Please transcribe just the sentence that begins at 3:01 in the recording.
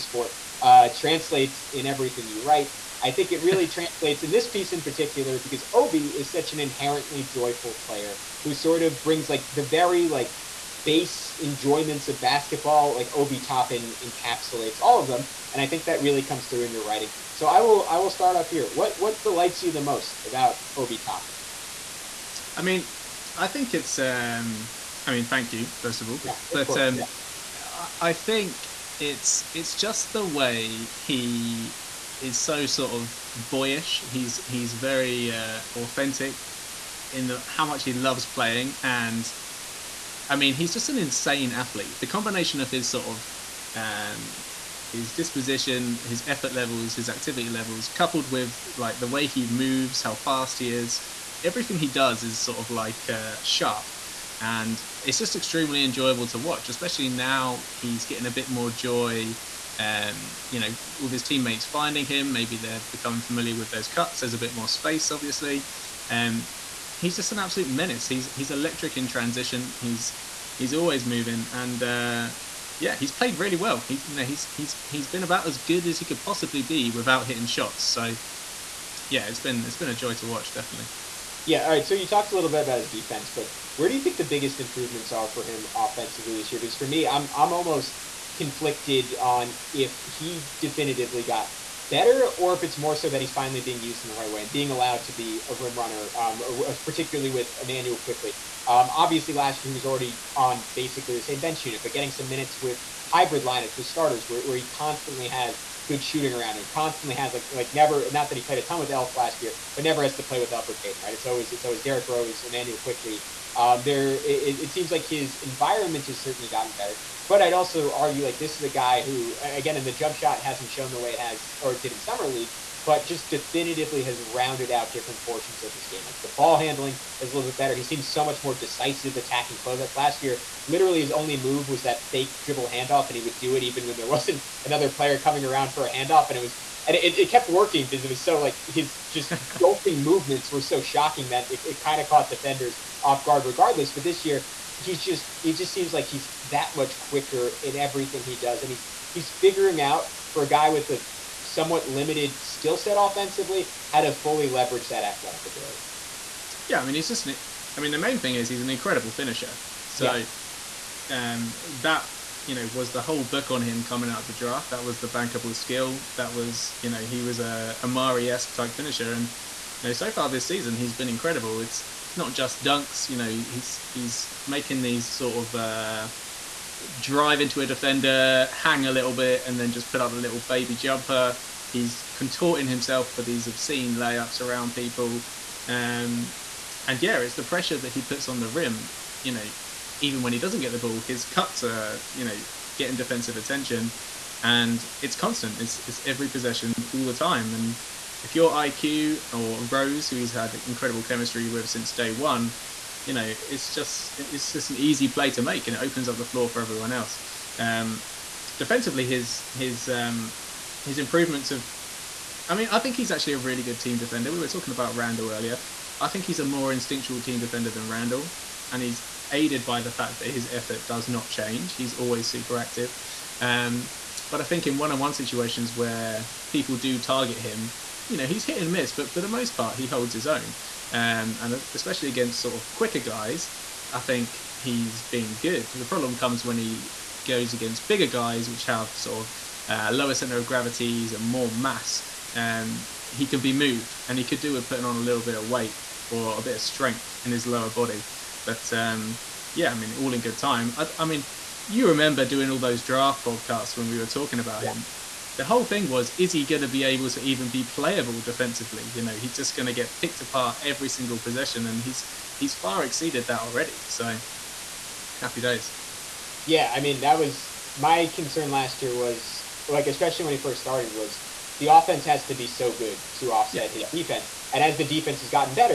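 He's contorting himself for these obscene layups around people.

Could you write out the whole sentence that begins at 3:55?
The problem comes when he goes against bigger guys, which have sort of uh, lower center of gravities and more mass.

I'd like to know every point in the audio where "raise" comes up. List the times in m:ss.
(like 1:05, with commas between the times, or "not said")
not said.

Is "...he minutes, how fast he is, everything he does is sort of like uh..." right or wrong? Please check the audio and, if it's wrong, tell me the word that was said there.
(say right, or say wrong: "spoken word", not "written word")
wrong: "moves", not "minutes".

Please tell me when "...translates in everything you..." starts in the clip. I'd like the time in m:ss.
0:00.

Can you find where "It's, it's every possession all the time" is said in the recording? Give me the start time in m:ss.
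3:15.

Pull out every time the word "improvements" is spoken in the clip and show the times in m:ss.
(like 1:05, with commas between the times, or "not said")
1:24, 3:30.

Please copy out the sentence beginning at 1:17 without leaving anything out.
So yeah, it's been it's been a joy to watch, definitely.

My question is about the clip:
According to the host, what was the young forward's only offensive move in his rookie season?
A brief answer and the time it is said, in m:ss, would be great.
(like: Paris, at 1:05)
fake dribble handoff, at 2:12.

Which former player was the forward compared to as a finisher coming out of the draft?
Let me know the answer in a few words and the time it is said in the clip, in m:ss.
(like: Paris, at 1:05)
Amar'e, at 2:47.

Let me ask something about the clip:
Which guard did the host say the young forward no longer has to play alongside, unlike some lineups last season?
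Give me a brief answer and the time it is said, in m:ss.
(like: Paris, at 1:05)
Elfrid Payton, at 1:50.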